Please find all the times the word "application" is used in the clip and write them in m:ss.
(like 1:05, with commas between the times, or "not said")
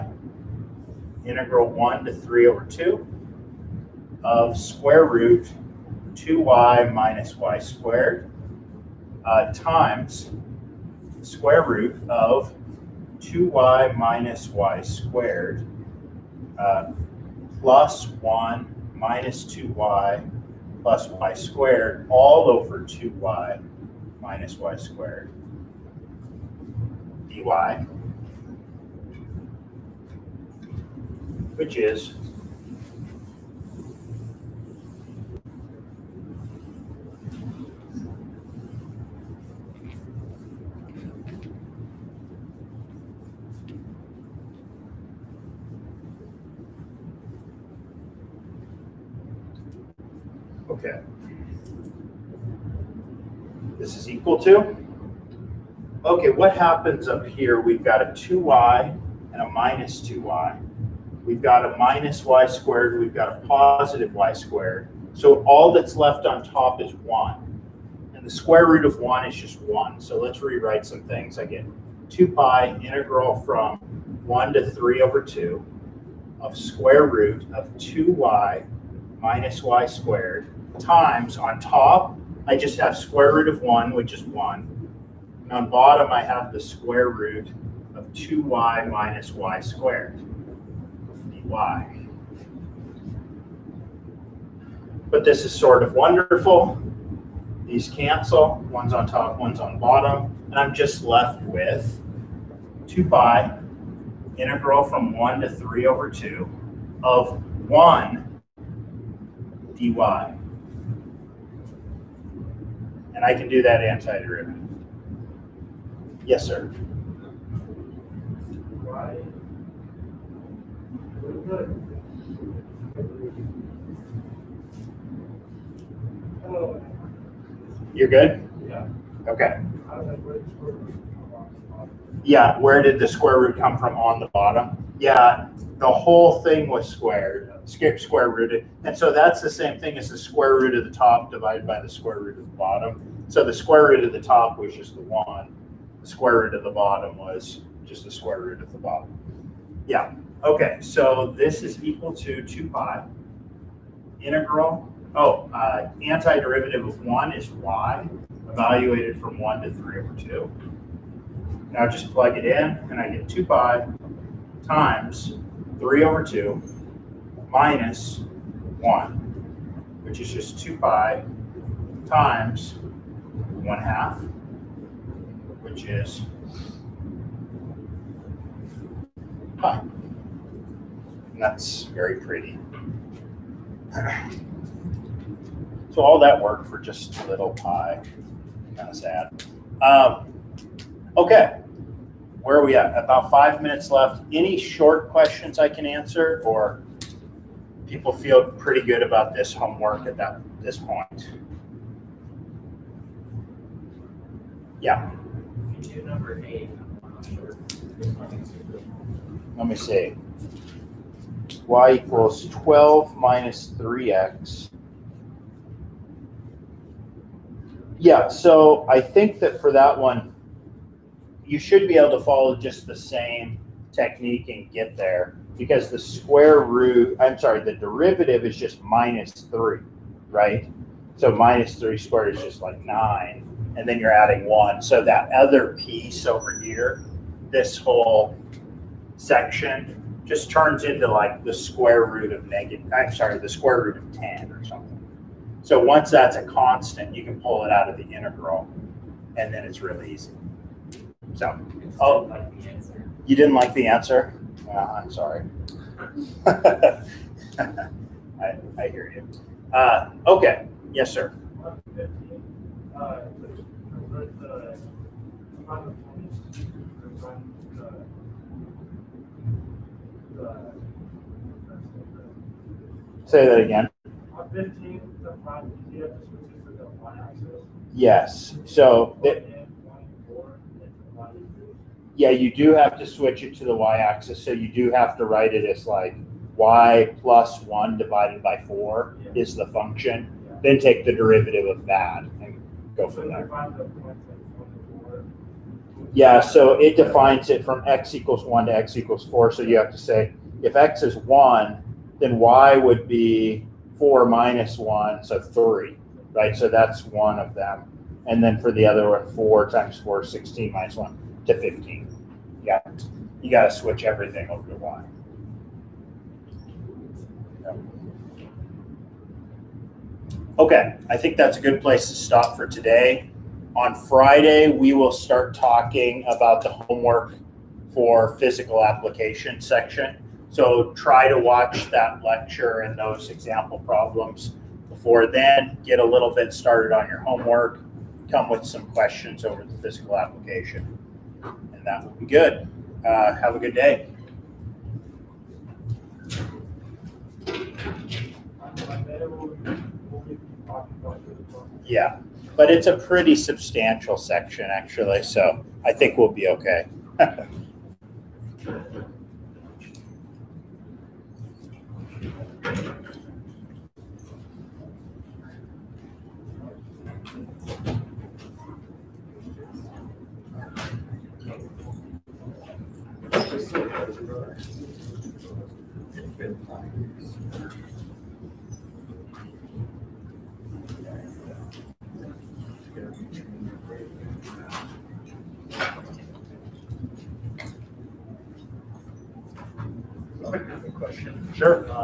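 5:28, 5:40.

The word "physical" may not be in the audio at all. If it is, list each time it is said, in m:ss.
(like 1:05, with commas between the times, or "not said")
5:28, 5:39.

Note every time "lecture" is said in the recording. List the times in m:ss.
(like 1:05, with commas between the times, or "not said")
5:32.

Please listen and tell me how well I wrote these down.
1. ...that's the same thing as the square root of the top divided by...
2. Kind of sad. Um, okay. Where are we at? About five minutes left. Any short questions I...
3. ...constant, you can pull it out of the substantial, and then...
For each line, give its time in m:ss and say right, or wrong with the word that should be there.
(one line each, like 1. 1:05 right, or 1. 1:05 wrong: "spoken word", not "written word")
1. 2:19 right
2. 3:08 right
3. 4:06 wrong: "integral", not "substantial".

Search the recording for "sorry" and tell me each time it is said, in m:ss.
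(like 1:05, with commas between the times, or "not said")
3:47, 4:03, 4:15.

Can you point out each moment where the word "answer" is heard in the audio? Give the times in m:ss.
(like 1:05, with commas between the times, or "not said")
3:15, 4:13.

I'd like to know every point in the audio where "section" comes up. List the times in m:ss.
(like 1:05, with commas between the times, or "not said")
3:59, 5:29, 5:54.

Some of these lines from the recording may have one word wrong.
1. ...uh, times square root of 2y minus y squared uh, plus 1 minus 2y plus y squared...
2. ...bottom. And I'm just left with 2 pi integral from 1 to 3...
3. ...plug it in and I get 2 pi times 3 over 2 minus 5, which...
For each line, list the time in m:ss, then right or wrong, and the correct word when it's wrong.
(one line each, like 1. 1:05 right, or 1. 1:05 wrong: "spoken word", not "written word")
1. 0:09 right
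2. 1:39 right
3. 2:42 wrong: "1", not "5".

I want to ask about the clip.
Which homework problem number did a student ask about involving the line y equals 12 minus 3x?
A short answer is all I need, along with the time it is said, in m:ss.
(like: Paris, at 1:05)
8, at 3:26.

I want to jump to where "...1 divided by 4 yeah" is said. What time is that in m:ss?
4:47.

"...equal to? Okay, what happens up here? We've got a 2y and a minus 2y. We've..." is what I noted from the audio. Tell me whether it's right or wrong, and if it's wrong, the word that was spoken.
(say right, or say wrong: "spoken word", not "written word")
right.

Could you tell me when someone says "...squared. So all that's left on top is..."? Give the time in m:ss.
1:04.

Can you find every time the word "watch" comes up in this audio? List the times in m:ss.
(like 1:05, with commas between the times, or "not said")
5:31.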